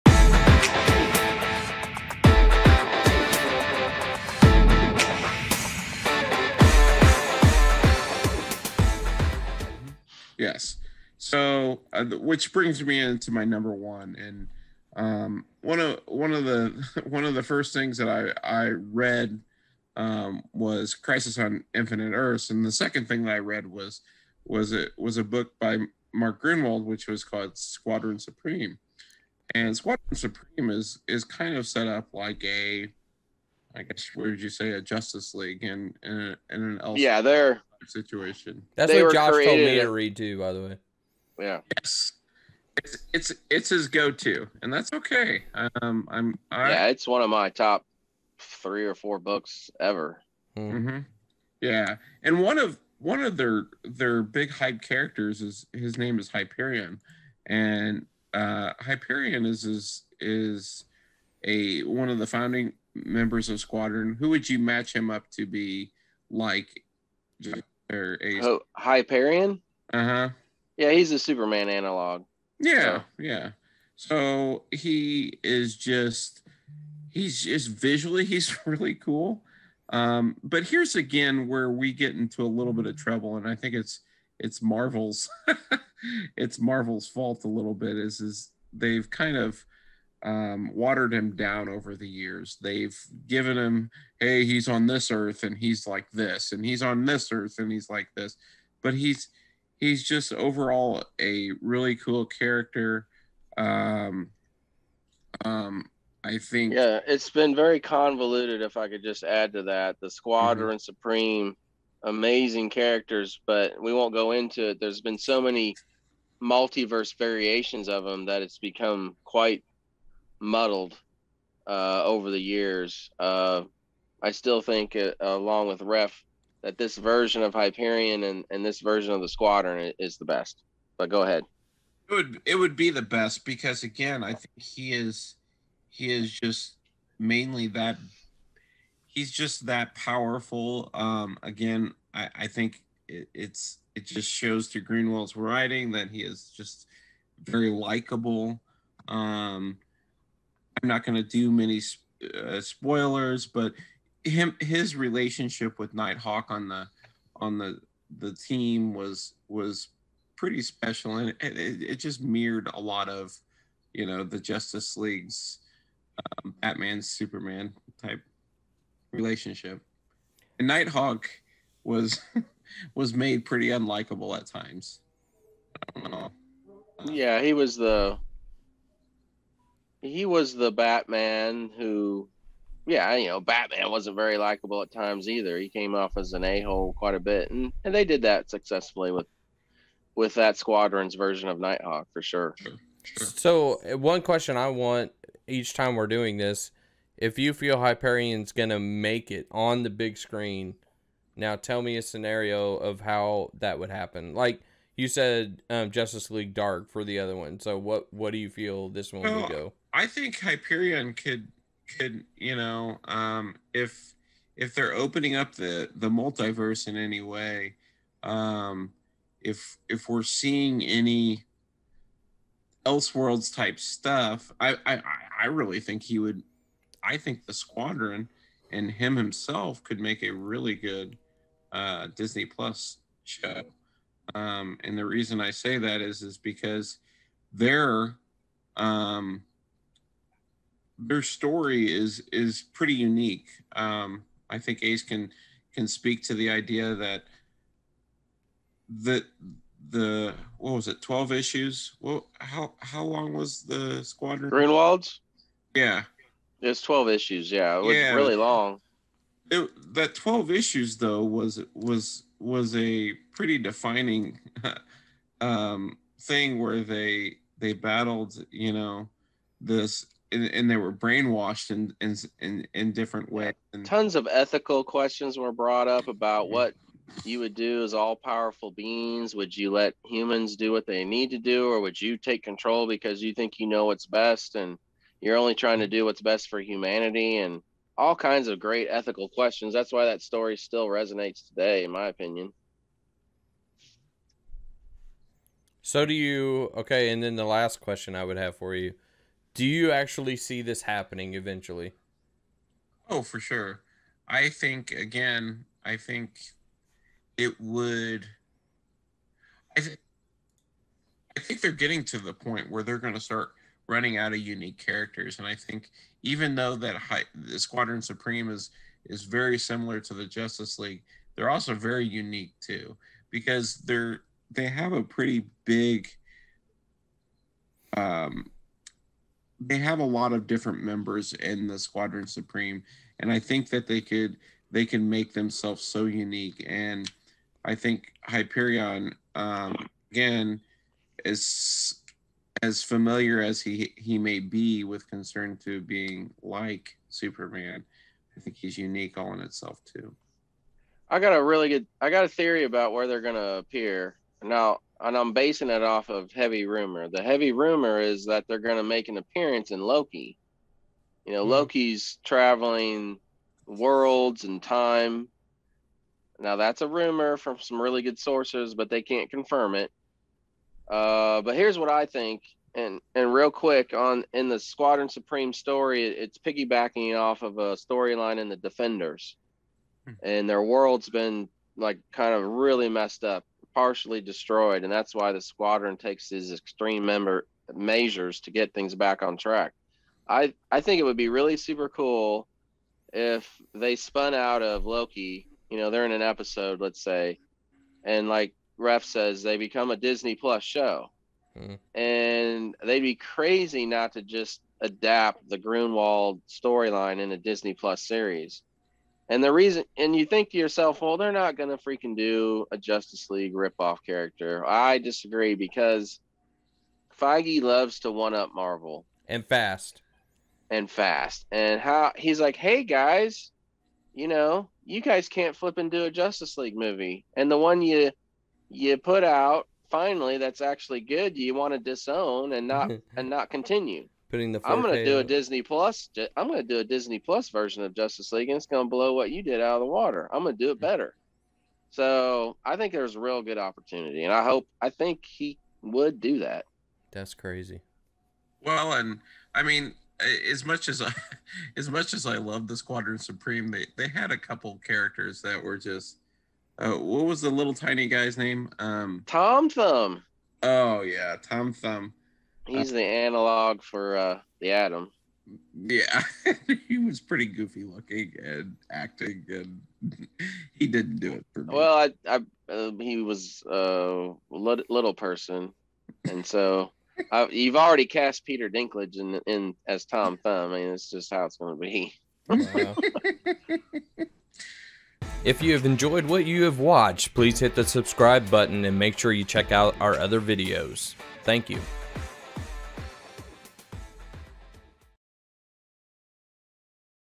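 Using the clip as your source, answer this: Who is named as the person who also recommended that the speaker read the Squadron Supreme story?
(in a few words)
Josh.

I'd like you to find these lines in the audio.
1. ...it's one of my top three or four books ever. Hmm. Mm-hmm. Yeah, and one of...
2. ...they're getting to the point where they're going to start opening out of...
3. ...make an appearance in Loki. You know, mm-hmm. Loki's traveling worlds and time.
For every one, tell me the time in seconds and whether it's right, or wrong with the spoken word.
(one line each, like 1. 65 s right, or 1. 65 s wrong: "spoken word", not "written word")
1. 46 s right
2. 311 s wrong: "running", not "opening"
3. 358 s right.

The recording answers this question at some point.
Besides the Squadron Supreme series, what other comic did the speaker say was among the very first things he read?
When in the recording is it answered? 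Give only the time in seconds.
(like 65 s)
20 s.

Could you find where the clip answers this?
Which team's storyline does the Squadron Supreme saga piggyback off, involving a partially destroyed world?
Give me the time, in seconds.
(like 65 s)
378 s.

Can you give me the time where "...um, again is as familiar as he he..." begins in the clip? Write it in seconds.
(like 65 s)
339 s.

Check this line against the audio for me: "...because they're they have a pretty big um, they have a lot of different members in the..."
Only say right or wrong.
right.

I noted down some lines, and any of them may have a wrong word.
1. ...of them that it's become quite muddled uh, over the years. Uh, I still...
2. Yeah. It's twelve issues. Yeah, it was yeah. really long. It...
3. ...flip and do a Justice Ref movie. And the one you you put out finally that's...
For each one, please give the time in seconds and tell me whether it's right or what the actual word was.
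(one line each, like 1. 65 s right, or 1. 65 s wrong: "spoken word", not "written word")
1. 117 s right
2. 255 s right
3. 425 s wrong: "League", not "Ref".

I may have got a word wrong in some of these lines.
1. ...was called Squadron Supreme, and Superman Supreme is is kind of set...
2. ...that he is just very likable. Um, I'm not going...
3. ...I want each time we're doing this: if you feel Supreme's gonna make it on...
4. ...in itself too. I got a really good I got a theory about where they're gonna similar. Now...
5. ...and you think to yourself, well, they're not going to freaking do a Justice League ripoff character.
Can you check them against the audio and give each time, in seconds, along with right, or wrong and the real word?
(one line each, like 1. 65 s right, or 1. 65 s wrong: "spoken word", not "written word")
1. 27 s wrong: "Squadron", not "Superman"
2. 145 s right
3. 194 s wrong: "Hyperion", not "Supreme"
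4. 349 s wrong: "appear", not "similar"
5. 409 s right.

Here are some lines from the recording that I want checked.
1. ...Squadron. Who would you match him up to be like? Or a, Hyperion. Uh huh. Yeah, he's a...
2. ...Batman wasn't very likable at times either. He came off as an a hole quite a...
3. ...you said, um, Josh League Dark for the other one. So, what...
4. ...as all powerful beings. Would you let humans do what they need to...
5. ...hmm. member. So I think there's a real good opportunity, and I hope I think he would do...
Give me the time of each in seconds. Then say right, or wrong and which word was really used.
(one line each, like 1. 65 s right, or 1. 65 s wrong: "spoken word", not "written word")
1. 63 s right
2. 183 s right
3. 204 s wrong: "Justice", not "Josh"
4. 277 s right
5. 440 s wrong: "better", not "member".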